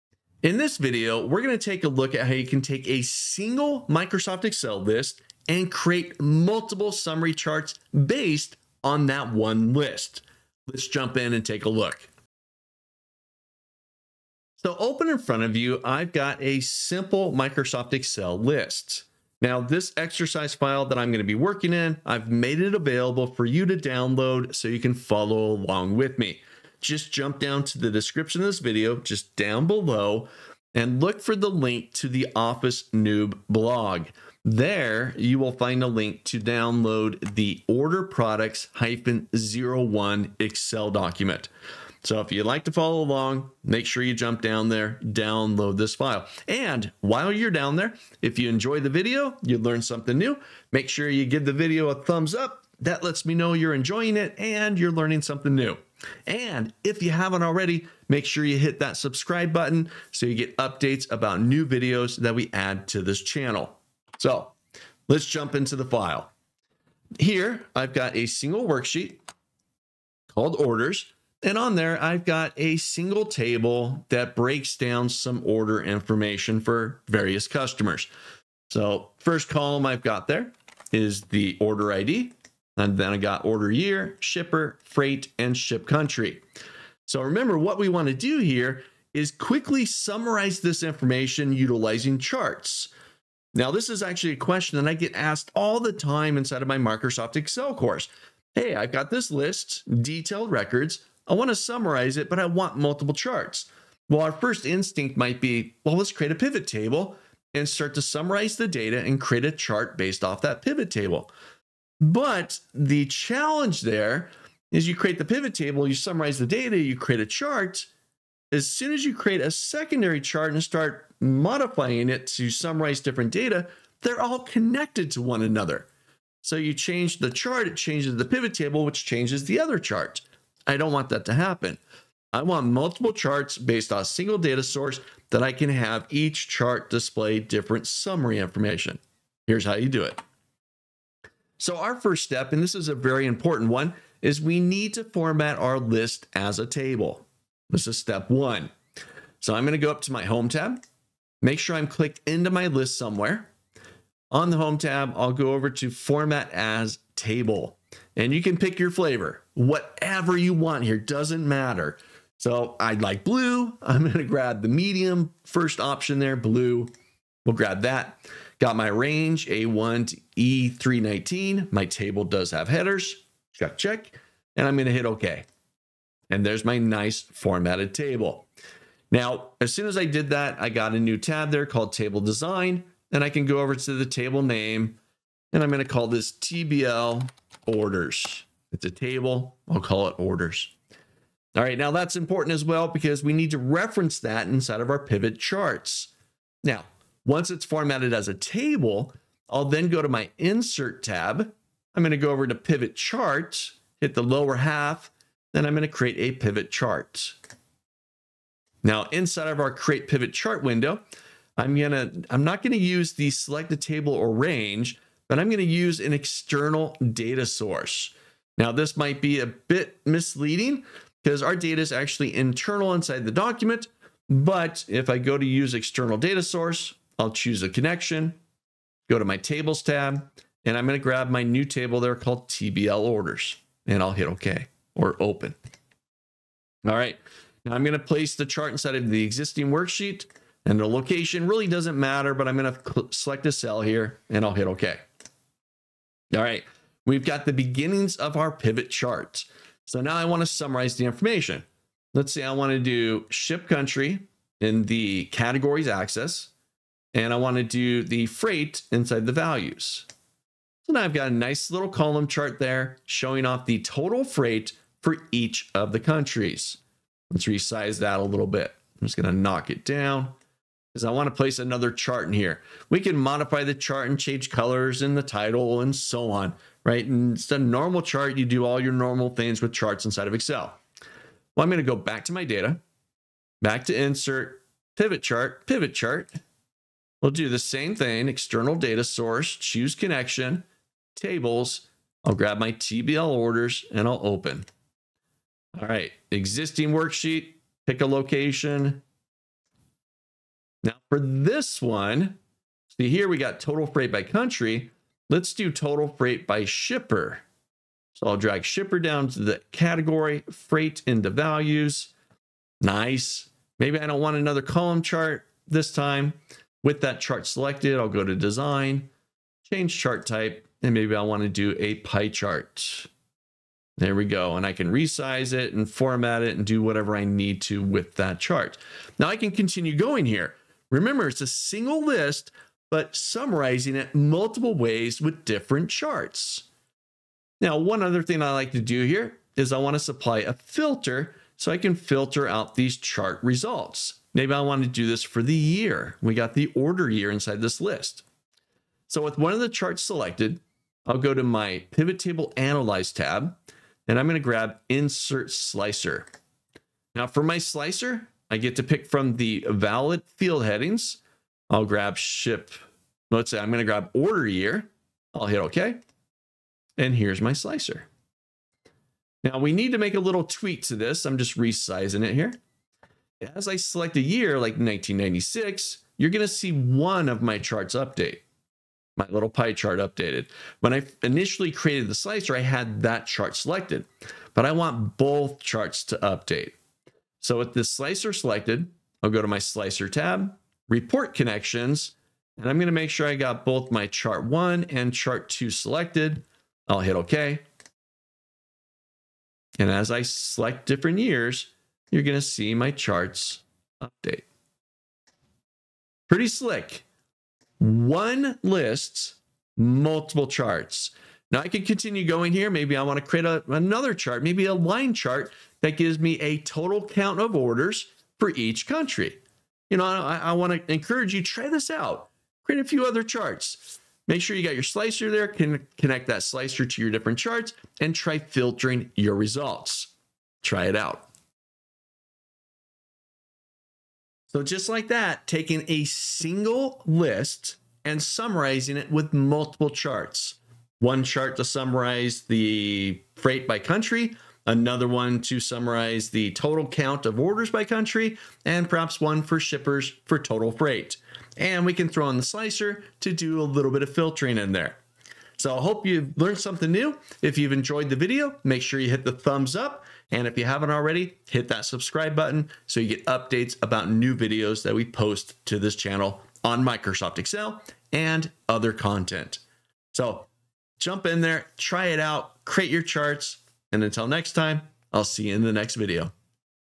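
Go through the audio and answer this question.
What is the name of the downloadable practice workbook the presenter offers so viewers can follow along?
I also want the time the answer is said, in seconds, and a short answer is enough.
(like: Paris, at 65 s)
order products-01, at 37 s.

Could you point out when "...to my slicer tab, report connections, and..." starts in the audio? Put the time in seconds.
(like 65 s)
389 s.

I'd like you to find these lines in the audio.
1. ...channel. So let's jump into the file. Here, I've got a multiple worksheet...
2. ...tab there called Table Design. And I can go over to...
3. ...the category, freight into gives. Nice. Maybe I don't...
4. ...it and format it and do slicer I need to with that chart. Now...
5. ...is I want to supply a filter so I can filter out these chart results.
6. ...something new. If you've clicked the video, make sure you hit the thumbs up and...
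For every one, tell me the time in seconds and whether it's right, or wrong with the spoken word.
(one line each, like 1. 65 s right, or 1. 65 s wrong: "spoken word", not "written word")
1. 63 s wrong: "single", not "multiple"
2. 181 s right
3. 309 s wrong: "values", not "gives"
4. 325 s wrong: "whatever", not "slicer"
5. 339 s right
6. 456 s wrong: "enjoyed", not "clicked".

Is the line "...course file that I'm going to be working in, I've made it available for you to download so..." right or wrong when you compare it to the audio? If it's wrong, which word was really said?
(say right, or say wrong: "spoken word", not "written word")
wrong: "exercise", not "course".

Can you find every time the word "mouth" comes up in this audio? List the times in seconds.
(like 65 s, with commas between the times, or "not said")
not said.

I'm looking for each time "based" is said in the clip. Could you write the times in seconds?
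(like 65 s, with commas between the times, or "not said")
8 s, 109 s, 133 s.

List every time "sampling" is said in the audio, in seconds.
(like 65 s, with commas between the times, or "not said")
not said.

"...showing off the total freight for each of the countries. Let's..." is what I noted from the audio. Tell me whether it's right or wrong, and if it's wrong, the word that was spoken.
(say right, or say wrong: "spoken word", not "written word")
right.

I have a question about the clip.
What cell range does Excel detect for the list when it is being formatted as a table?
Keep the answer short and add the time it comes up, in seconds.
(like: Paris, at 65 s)
A1 to E319, at 169 s.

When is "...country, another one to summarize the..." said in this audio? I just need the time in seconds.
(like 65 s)
443 s.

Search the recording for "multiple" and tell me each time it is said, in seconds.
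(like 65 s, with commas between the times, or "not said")
6 s, 102 s, 132 s, 334 s, 409 s, 439 s.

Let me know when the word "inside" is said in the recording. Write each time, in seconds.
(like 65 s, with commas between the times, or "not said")
96 s, 194 s, 209 s, 222 s, 238 s, 258 s, 280 s, 347 s.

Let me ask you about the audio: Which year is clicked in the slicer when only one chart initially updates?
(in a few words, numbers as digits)
1996.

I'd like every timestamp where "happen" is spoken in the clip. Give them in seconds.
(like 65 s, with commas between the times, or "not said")
131 s.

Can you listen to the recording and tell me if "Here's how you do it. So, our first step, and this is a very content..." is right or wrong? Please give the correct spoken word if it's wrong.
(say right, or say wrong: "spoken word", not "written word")
wrong: "important", not "content".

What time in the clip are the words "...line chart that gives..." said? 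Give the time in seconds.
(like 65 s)
414 s.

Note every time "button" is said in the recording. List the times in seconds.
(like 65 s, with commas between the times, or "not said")
59 s, 462 s.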